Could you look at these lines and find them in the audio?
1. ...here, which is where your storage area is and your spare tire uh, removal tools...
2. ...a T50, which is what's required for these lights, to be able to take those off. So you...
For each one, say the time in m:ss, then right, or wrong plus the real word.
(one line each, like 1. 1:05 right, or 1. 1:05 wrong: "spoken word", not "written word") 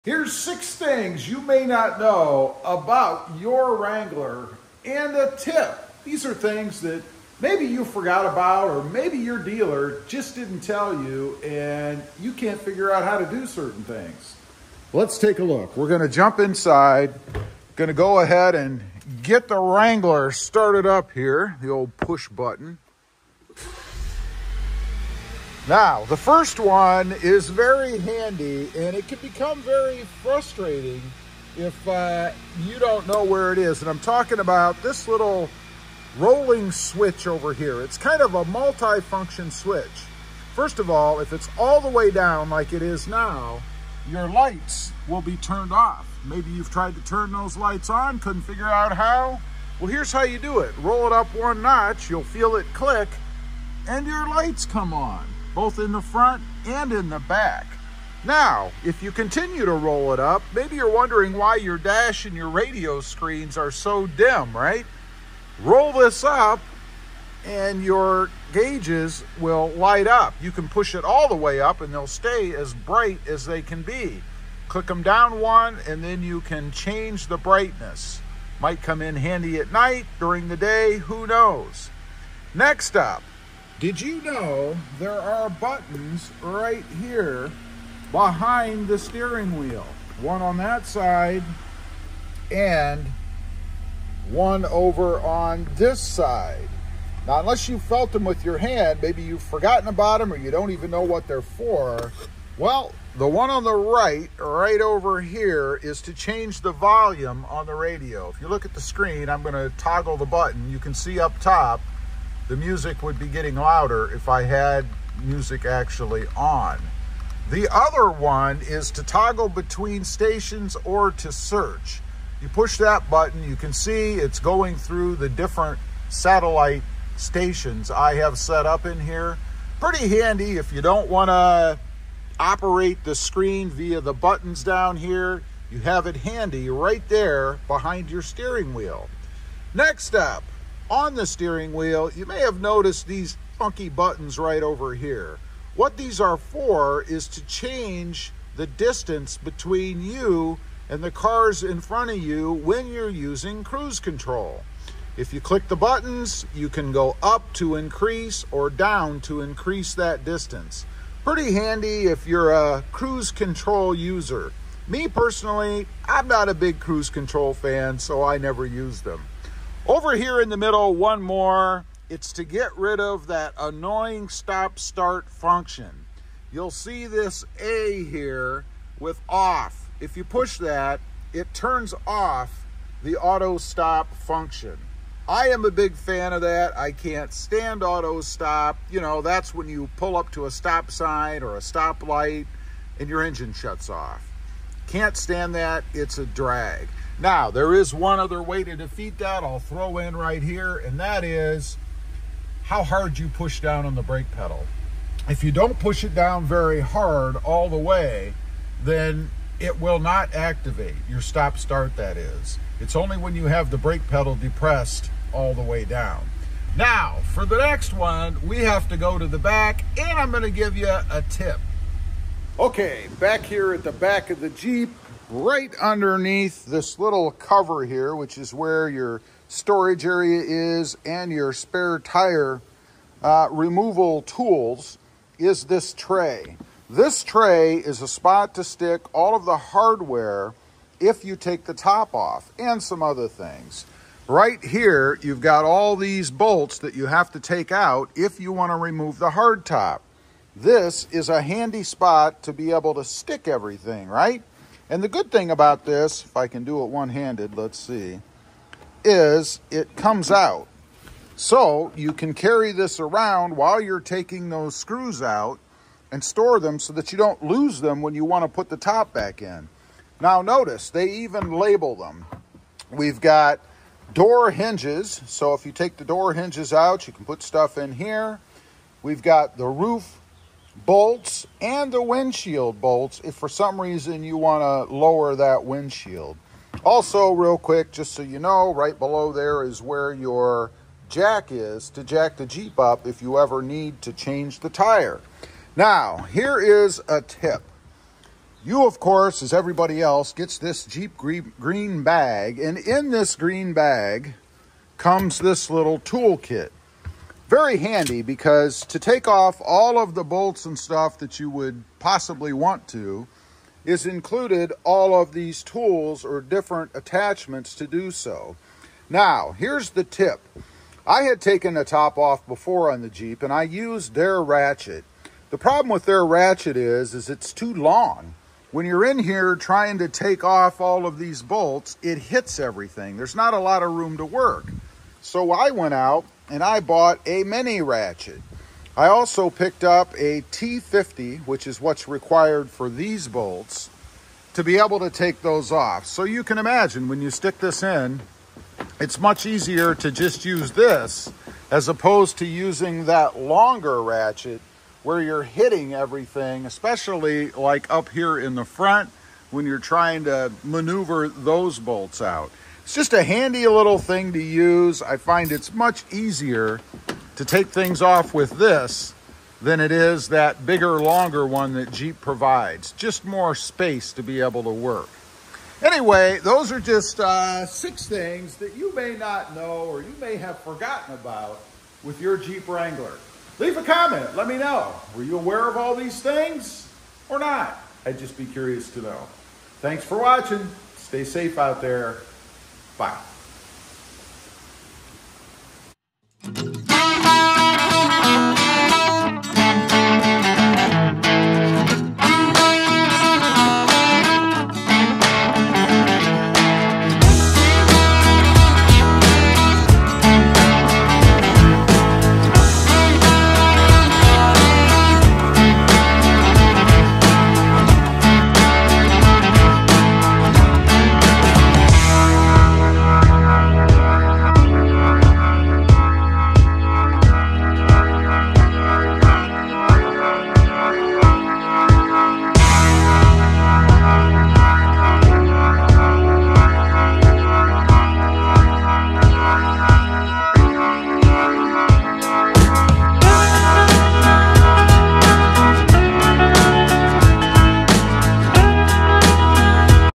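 1. 3:47 right
2. 5:40 wrong: "bolts", not "lights".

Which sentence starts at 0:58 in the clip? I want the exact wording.
Now, if you continue to roll it up, maybe you're wondering why your dash and your radio screens are so dim, right?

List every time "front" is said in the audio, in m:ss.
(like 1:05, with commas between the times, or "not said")
0:56, 2:31, 5:58.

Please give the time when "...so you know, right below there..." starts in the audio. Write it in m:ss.
4:48.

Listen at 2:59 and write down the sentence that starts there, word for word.
If you push that, it turns off the auto stop function.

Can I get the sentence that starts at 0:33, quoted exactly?
And I'm talking about this little rolling switch over here.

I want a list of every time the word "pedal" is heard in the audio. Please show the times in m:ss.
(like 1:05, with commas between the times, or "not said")
3:24, 3:34.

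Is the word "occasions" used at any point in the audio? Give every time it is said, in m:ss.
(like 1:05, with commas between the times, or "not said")
not said.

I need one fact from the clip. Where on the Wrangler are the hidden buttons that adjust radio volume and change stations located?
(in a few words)
behind the steering wheel.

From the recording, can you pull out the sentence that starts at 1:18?
Might come in handy at night, during the day, who knows.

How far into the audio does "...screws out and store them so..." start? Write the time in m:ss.
4:24.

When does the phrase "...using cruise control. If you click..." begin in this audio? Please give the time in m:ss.
2:33.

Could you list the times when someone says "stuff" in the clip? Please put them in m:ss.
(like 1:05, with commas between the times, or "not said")
4:37, 5:10.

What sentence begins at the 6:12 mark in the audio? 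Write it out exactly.
Just more space to be able to work.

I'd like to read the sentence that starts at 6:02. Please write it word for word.
It's just a handy little thing to use.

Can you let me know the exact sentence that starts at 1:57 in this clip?
The other one is to toggle between stations or to search.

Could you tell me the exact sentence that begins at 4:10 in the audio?
This is a handy spot to be able to stick everything, right?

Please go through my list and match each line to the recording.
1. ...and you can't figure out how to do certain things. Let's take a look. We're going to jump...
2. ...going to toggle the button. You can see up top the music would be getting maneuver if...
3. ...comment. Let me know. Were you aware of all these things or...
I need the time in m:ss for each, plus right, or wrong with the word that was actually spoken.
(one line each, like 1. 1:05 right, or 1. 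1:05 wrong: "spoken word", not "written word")
1. 0:11 right
2. 1:49 wrong: "louder", not "maneuver"
3. 6:23 right.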